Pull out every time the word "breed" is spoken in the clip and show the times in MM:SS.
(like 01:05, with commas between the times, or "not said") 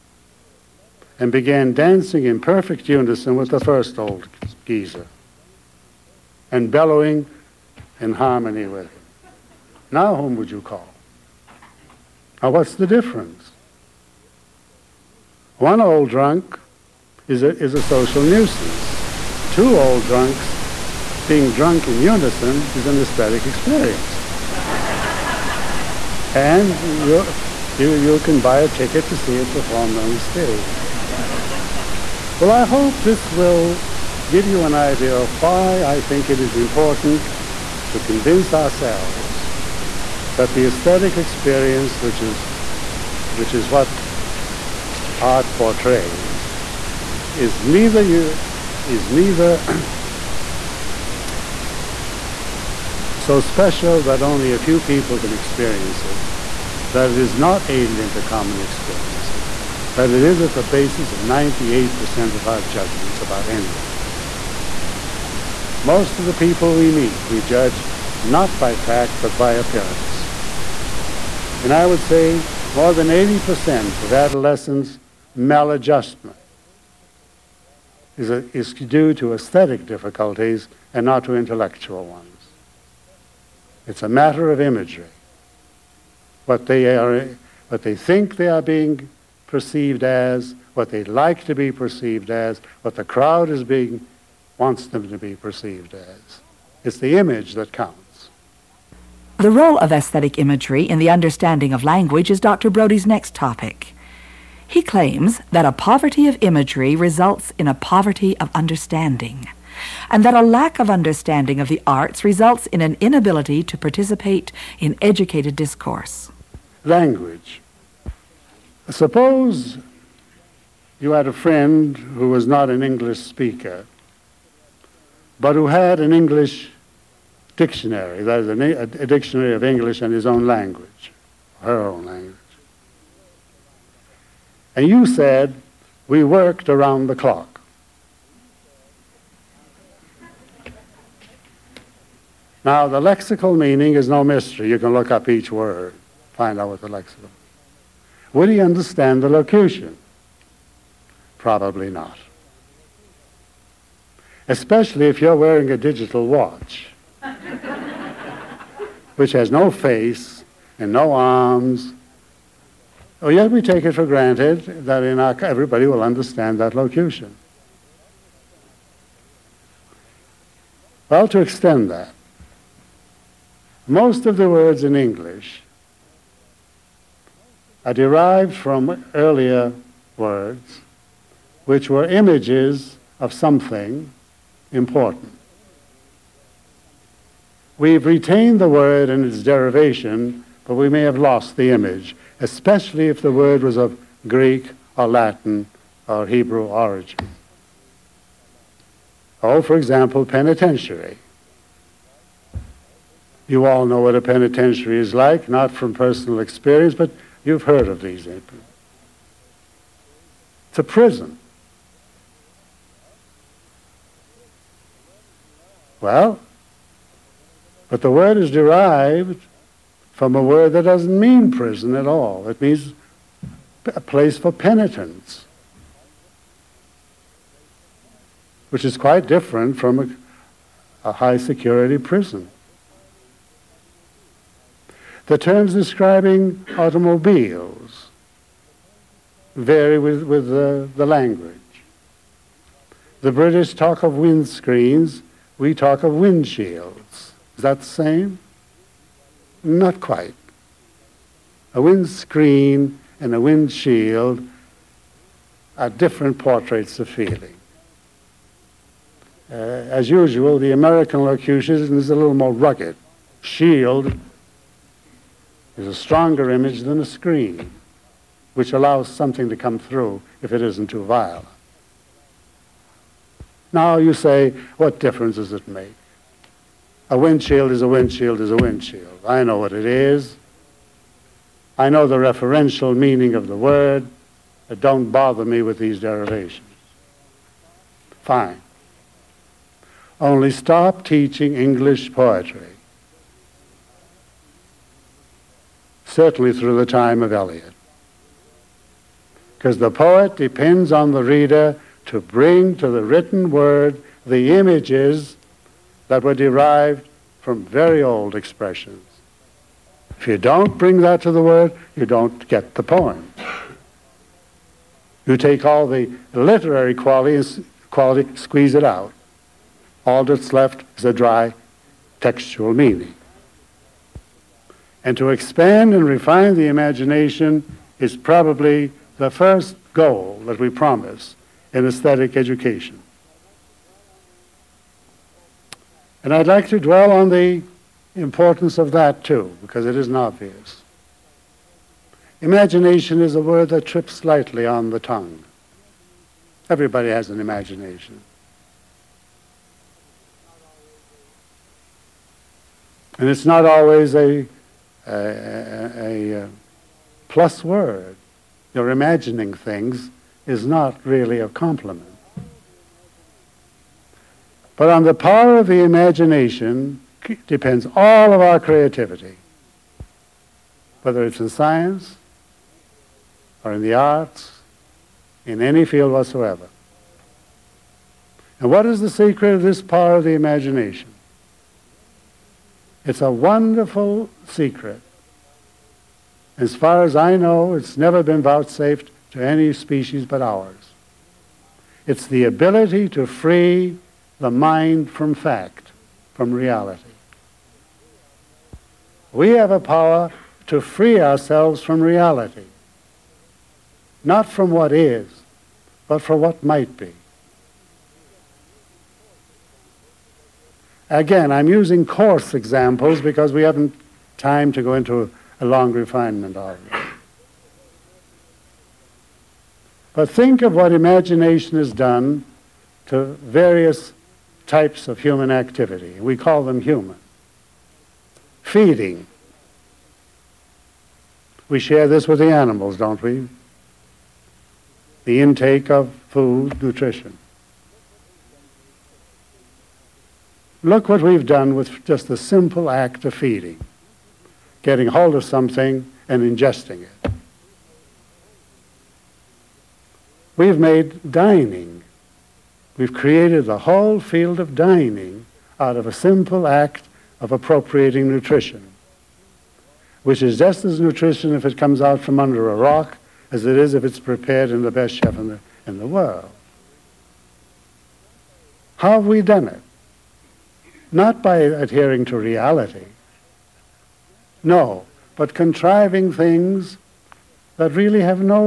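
not said.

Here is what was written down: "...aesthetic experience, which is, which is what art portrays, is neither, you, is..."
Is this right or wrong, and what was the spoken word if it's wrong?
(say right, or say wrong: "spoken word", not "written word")
right.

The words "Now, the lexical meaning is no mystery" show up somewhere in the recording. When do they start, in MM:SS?
02:22.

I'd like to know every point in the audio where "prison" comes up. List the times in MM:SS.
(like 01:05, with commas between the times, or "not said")
03:30, 03:41, 03:51.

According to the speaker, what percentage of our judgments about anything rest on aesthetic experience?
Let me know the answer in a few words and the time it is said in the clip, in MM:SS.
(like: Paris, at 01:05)
98%, at 01:01.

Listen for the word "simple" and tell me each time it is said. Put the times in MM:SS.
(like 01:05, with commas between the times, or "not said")
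07:22, 07:36.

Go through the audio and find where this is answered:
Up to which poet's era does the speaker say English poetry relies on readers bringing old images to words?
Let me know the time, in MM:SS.
04:57.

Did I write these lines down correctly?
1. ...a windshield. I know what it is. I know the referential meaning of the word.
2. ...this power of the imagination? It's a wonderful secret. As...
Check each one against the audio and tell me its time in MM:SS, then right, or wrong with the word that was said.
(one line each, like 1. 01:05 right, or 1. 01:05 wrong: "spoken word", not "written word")
1. 04:38 right
2. 06:19 right.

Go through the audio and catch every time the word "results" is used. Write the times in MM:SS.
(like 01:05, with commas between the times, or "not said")
01:46, 01:52.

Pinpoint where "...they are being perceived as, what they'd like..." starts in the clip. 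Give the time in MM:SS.
01:28.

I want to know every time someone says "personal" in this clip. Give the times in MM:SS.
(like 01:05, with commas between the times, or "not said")
03:25.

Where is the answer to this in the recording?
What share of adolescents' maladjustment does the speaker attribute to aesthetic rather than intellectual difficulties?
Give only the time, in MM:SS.
01:12.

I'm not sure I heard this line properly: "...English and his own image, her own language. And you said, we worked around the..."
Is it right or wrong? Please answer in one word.
wrong.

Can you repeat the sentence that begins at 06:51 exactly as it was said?
Again, I'm using coarse examples because we haven't time to go into a long refinement of it.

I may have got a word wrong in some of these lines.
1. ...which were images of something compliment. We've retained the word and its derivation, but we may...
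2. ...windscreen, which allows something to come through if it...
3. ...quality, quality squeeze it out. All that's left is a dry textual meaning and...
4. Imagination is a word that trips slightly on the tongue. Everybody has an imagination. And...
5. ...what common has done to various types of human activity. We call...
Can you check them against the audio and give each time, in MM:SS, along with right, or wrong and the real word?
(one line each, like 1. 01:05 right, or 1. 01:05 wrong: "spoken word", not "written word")
1. 03:01 wrong: "important", not "compliment"
2. 04:27 wrong: "screen", not "windscreen"
3. 05:16 right
4. 05:42 right
5. 07:00 wrong: "imagination", not "common".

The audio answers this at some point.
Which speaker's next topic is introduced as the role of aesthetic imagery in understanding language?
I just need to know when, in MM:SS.
01:42.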